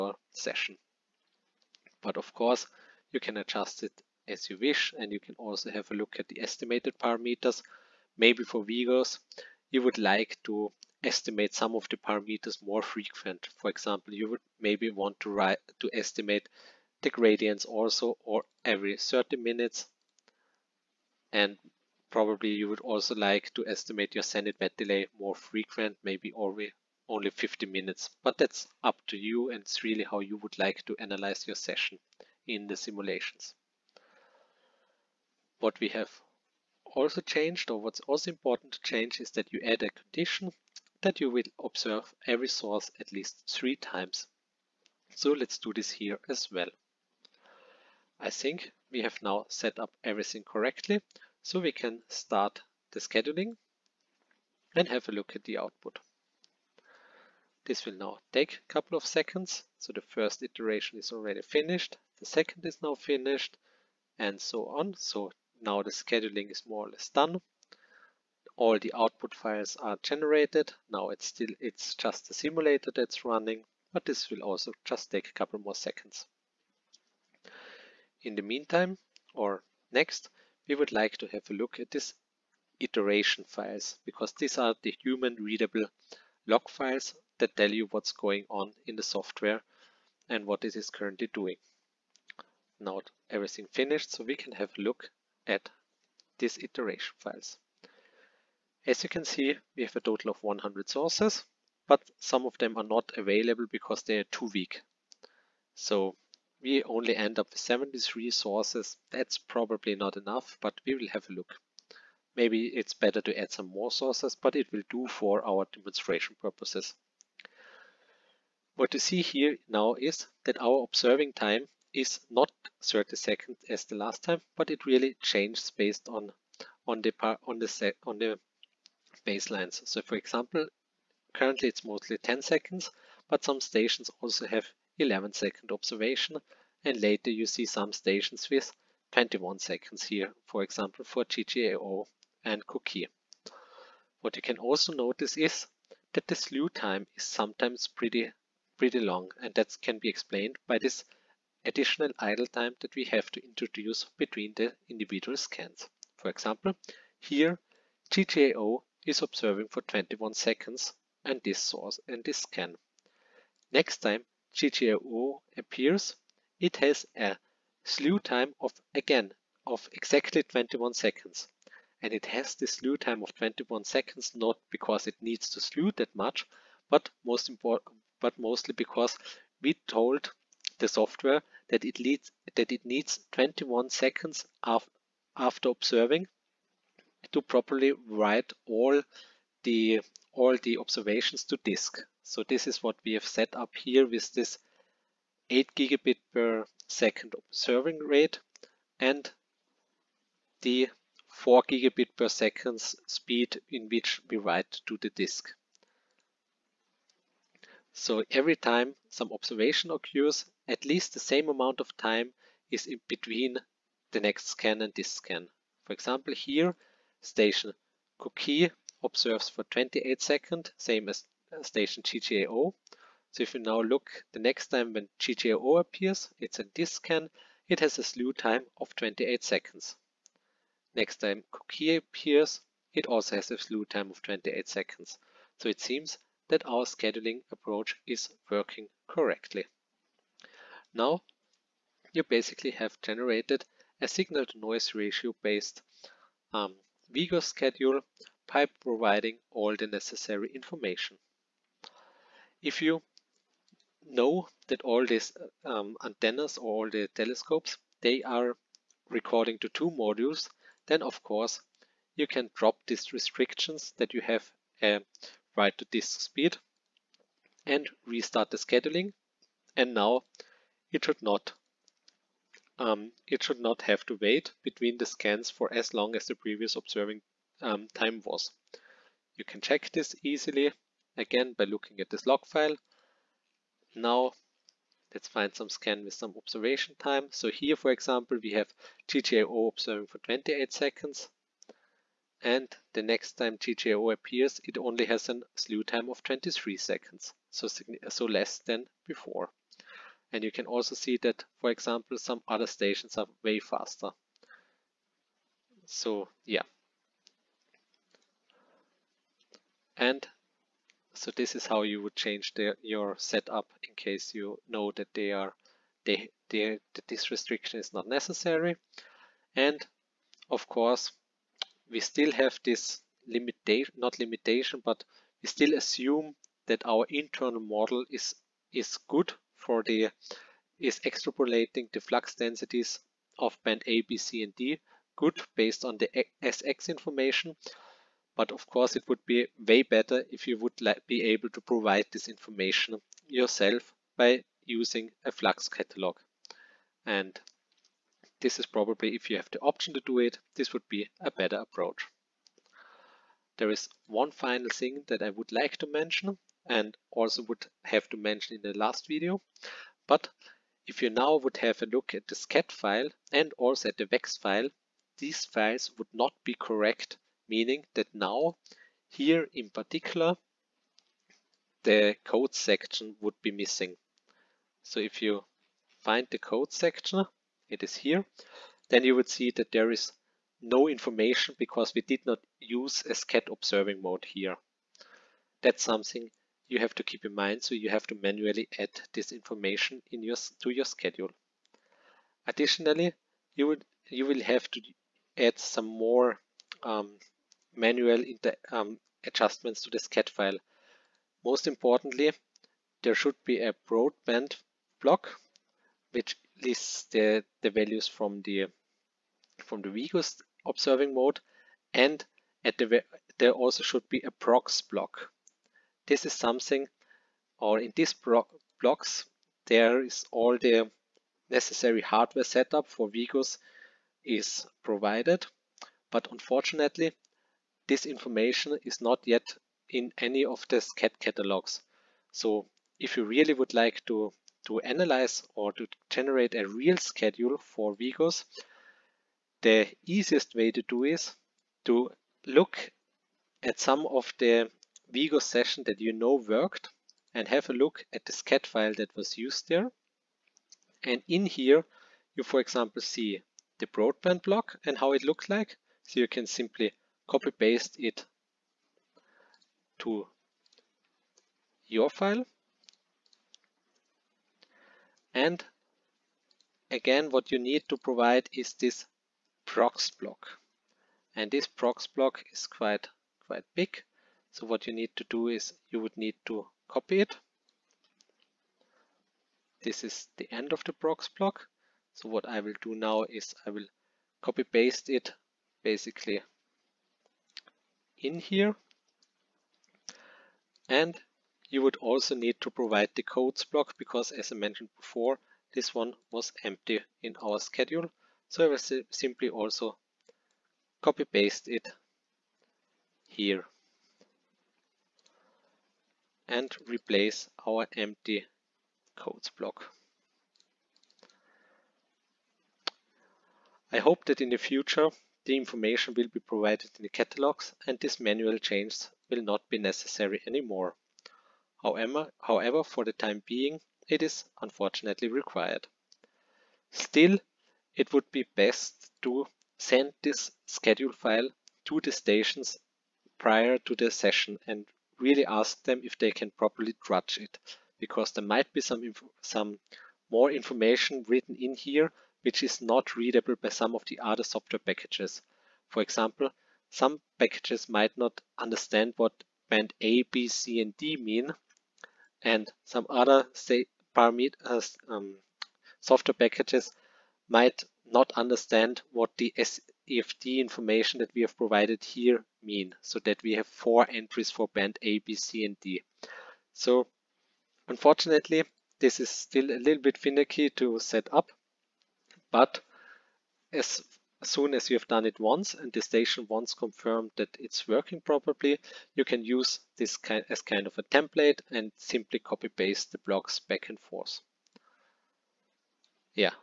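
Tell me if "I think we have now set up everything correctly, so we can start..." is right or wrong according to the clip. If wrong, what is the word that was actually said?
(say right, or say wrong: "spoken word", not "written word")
right.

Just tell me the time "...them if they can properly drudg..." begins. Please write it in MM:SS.
08:55.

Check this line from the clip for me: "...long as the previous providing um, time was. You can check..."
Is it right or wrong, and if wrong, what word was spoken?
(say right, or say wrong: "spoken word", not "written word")
wrong: "observing", not "providing".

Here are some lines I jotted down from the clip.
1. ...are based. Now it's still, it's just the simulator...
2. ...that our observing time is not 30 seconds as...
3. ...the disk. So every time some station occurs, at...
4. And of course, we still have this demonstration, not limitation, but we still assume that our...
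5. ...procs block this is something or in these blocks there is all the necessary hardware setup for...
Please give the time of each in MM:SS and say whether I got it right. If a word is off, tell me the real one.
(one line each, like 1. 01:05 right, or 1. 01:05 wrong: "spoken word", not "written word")
1. 01:09 wrong: "generated", not "based"
2. 02:00 right
3. 03:25 wrong: "observation", not "station"
4. 05:19 wrong: "limitation", not "demonstration"
5. 06:54 right.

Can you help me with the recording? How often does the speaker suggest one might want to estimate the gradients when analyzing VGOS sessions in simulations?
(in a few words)
every 30 minutes.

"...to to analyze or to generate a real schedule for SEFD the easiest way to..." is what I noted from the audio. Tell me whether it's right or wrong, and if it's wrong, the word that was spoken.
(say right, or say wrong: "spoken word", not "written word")
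wrong: "VGOS", not "SEFD".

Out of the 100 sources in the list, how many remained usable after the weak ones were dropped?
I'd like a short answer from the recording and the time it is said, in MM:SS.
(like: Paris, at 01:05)
73, at 01:47.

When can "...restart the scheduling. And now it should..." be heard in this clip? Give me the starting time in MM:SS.
04:28.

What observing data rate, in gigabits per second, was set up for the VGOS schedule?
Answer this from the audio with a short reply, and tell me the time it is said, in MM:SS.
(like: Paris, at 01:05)
8 gigabit per second, at 03:15.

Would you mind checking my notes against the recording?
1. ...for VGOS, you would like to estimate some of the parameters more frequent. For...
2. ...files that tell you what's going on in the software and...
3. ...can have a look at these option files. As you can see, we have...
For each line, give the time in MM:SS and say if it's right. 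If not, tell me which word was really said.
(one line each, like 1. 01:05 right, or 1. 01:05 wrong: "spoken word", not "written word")
1. 00:08 right
2. 01:26 right
3. 01:34 wrong: "iteration", not "option".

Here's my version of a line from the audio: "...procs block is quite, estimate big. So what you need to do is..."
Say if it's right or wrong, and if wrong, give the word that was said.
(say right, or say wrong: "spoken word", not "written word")
wrong: "quite", not "estimate".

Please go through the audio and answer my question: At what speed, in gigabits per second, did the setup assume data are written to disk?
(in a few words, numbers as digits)
4 gigabit per second.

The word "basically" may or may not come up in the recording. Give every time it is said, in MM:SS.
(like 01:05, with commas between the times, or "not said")
04:02, 08:05.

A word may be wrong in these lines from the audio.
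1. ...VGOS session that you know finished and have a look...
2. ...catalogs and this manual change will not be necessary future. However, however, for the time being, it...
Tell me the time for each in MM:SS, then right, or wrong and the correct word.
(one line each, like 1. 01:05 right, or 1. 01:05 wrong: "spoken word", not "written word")
1. 07:25 wrong: "worked", not "finished"
2. 08:37 wrong: "anymore", not "future".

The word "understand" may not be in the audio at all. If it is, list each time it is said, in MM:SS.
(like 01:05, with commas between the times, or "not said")
09:08, 09:18.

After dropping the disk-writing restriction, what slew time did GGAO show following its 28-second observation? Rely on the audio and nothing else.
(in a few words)
23 seconds.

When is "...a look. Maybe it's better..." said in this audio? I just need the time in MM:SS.
01:51.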